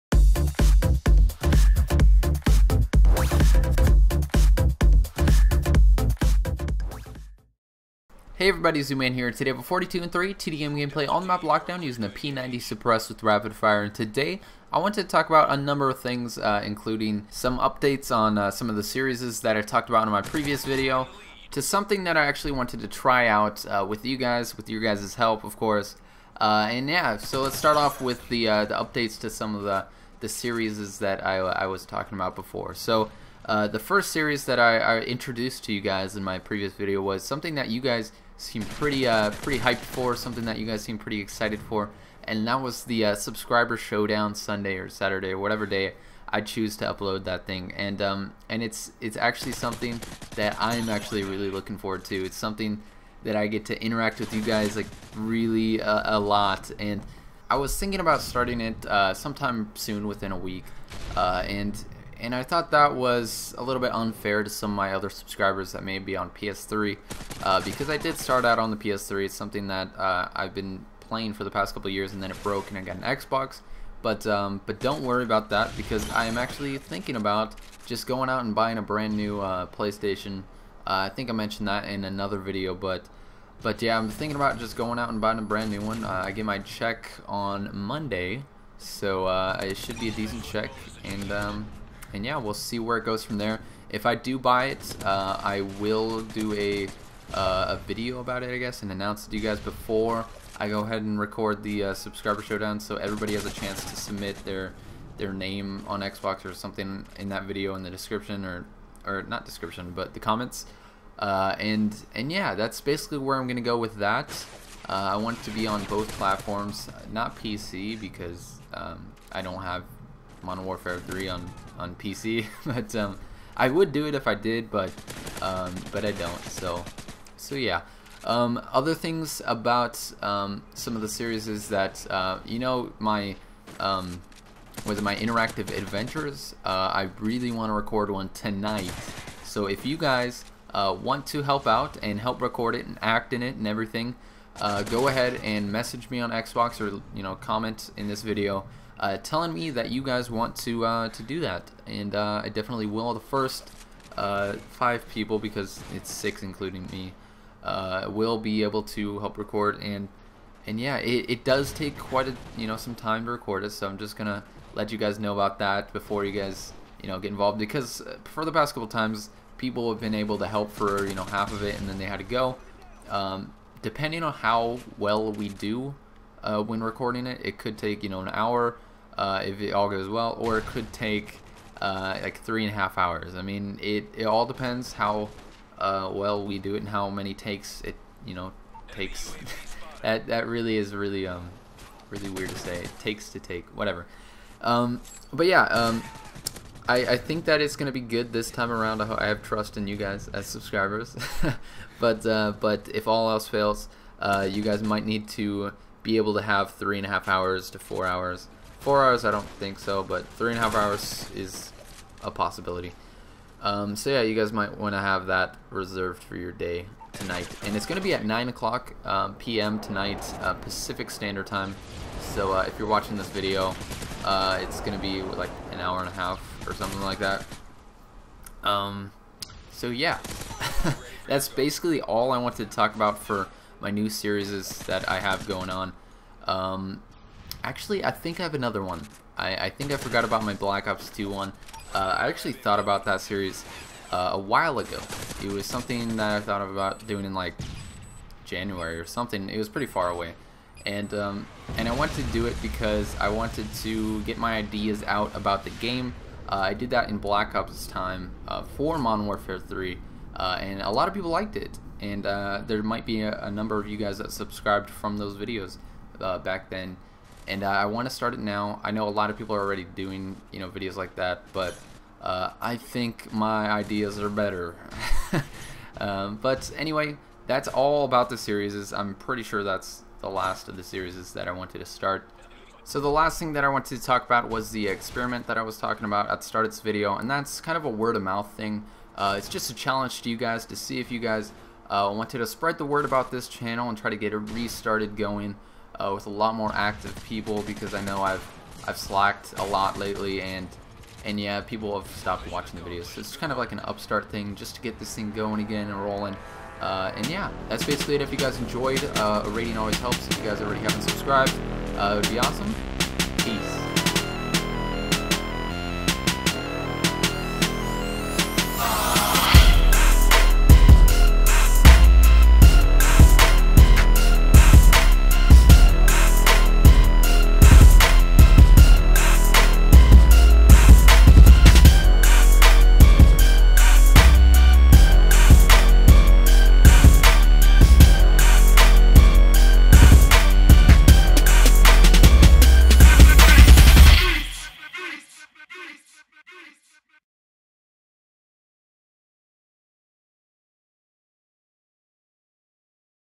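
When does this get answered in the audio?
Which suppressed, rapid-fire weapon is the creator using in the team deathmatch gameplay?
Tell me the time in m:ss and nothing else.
0:12.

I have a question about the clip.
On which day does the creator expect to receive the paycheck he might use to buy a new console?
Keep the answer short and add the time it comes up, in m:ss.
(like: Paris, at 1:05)
Monday, at 1:27.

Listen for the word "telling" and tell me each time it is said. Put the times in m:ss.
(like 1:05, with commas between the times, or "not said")
2:29.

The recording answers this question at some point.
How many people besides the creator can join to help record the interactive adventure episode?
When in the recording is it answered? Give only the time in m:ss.
2:34.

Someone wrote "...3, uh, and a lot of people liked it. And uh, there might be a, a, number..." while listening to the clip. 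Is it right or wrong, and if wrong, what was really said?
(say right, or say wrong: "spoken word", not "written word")
right.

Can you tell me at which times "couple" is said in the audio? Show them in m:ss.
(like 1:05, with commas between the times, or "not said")
1:11, 2:48.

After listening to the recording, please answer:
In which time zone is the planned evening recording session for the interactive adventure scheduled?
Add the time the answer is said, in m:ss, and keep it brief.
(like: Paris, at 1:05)
Pacific Standard Time, at 3:40.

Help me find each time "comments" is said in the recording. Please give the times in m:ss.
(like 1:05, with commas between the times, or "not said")
1:50, 2:27.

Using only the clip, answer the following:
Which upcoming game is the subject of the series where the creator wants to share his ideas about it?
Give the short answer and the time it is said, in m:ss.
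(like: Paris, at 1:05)
Black Ops 2, at 4:00.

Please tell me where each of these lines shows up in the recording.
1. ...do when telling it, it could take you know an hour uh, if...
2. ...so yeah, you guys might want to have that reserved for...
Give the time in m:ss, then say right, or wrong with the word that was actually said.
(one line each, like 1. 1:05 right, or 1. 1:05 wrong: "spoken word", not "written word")
1. 2:55 wrong: "recording", not "telling"
2. 3:33 right.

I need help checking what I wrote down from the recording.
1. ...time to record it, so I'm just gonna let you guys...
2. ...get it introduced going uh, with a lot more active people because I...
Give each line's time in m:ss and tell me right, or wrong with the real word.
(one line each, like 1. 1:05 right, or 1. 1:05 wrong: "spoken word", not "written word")
1. 2:42 right
2. 4:54 wrong: "restarted", not "introduced".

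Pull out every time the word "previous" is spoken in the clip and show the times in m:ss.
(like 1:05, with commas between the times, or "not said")
0:20, 0:36.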